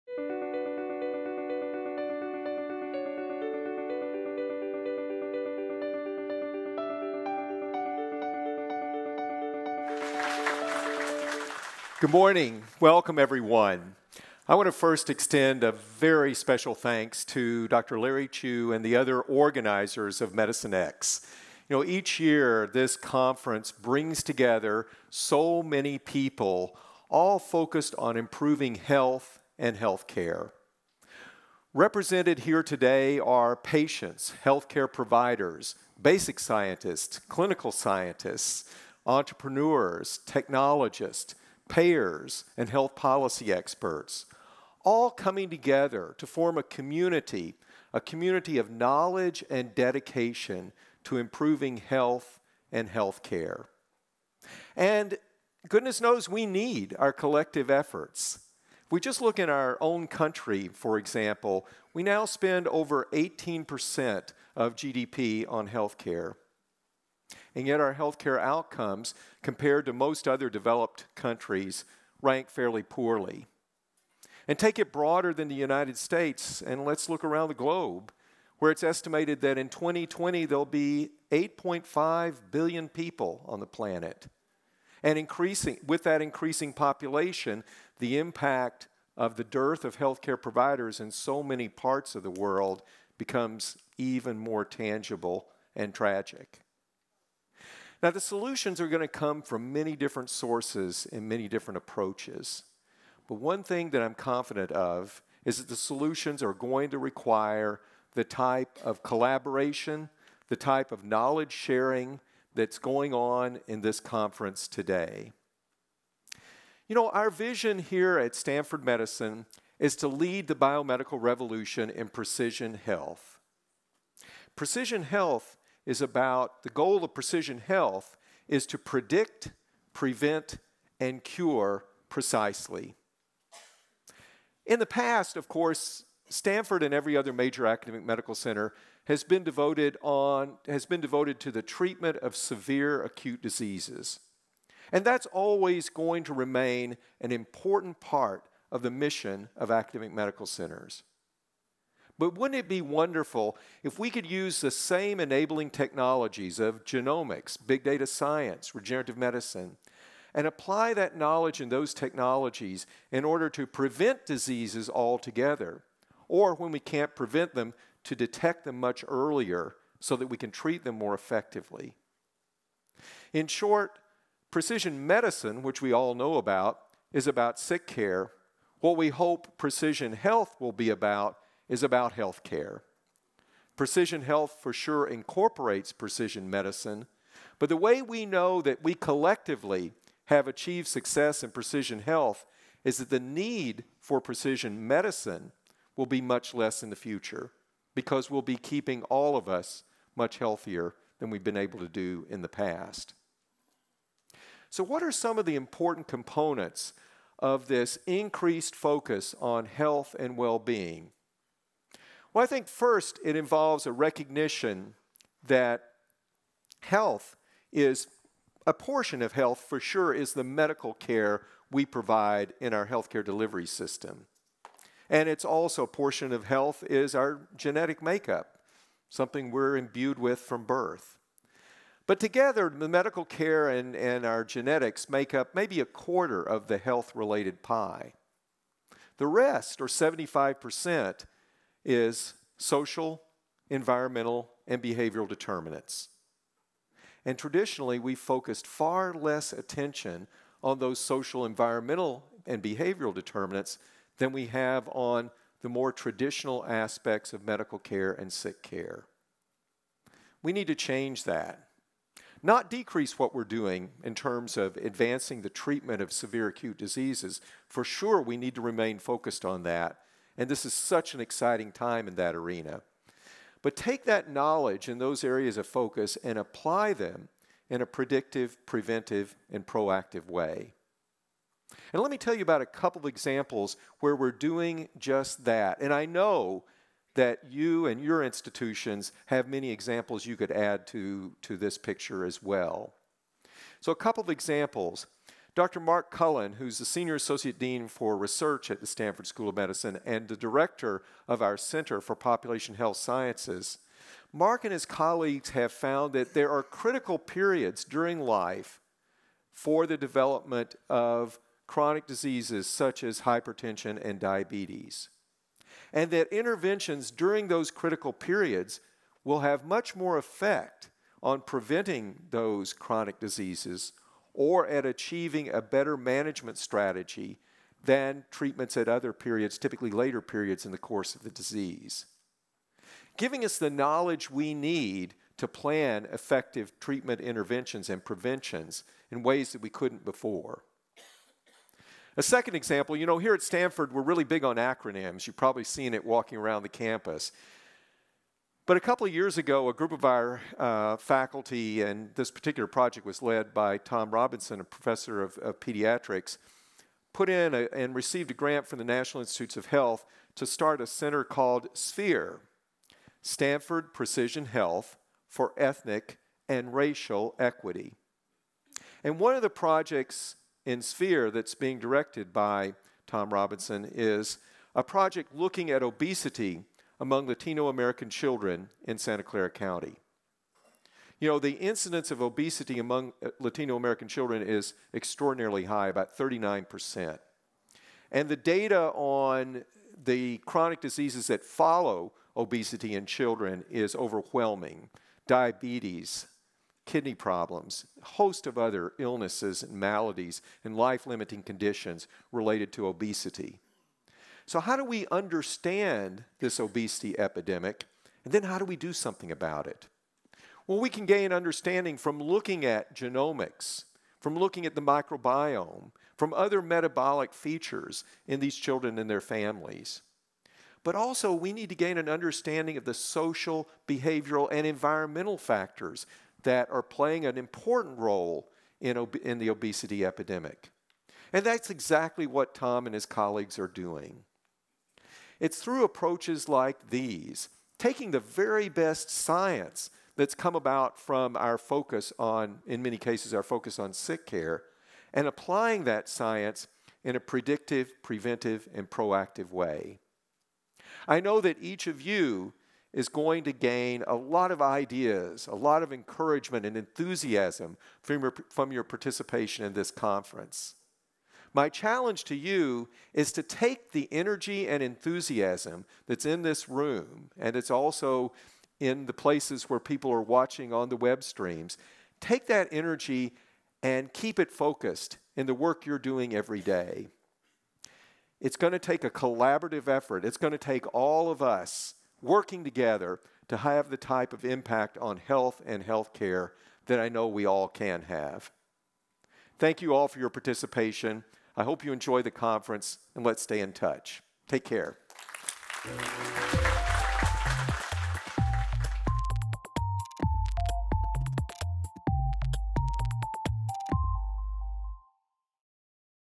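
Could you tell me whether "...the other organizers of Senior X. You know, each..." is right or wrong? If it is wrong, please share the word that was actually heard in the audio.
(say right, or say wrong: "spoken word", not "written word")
wrong: "Medicine", not "Senior".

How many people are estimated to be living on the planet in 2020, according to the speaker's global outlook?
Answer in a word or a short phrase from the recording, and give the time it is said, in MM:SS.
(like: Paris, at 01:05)
8.5 billion, at 01:21.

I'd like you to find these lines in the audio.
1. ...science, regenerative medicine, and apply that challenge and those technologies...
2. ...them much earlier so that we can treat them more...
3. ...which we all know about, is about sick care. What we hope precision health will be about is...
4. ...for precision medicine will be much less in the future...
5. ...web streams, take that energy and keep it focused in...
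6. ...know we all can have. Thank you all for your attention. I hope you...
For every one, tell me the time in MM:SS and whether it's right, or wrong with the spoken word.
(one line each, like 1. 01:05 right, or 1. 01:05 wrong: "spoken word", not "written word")
1. 02:38 wrong: "knowledge", not "challenge"
2. 02:48 right
3. 02:55 right
4. 03:14 right
5. 07:50 right
6. 08:07 wrong: "participation", not "attention".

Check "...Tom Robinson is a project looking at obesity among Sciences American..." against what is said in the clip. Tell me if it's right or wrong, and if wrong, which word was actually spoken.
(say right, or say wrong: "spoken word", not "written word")
wrong: "Latino", not "Sciences".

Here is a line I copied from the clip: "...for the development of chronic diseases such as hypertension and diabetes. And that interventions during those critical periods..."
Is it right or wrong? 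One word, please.
right.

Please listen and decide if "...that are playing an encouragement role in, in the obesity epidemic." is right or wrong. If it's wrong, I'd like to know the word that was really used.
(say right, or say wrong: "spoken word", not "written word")
wrong: "important", not "encouragement".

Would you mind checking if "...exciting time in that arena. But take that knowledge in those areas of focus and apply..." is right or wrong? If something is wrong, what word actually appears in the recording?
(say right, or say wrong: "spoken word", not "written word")
right.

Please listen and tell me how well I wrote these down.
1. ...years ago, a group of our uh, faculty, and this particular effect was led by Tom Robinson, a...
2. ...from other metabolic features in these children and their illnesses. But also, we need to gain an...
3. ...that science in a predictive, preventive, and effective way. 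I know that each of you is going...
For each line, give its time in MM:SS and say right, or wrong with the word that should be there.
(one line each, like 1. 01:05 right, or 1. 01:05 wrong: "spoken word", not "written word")
1. 05:49 wrong: "project", not "effect"
2. 06:56 wrong: "families", not "illnesses"
3. 07:25 wrong: "proactive", not "effective".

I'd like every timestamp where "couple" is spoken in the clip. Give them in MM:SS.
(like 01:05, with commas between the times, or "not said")
04:42, 04:53, 05:48.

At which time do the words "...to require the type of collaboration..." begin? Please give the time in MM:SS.
01:46.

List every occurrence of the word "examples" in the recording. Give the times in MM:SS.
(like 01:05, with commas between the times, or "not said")
01:00, 04:43, 04:49, 04:54, 05:42.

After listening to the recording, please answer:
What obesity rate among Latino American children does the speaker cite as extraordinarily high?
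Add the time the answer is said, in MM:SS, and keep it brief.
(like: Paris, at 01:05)
39%, at 06:26.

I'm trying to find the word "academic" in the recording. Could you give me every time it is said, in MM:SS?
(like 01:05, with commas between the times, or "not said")
02:17, 02:29.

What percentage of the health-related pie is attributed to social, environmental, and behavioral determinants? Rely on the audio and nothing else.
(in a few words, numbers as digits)
75%.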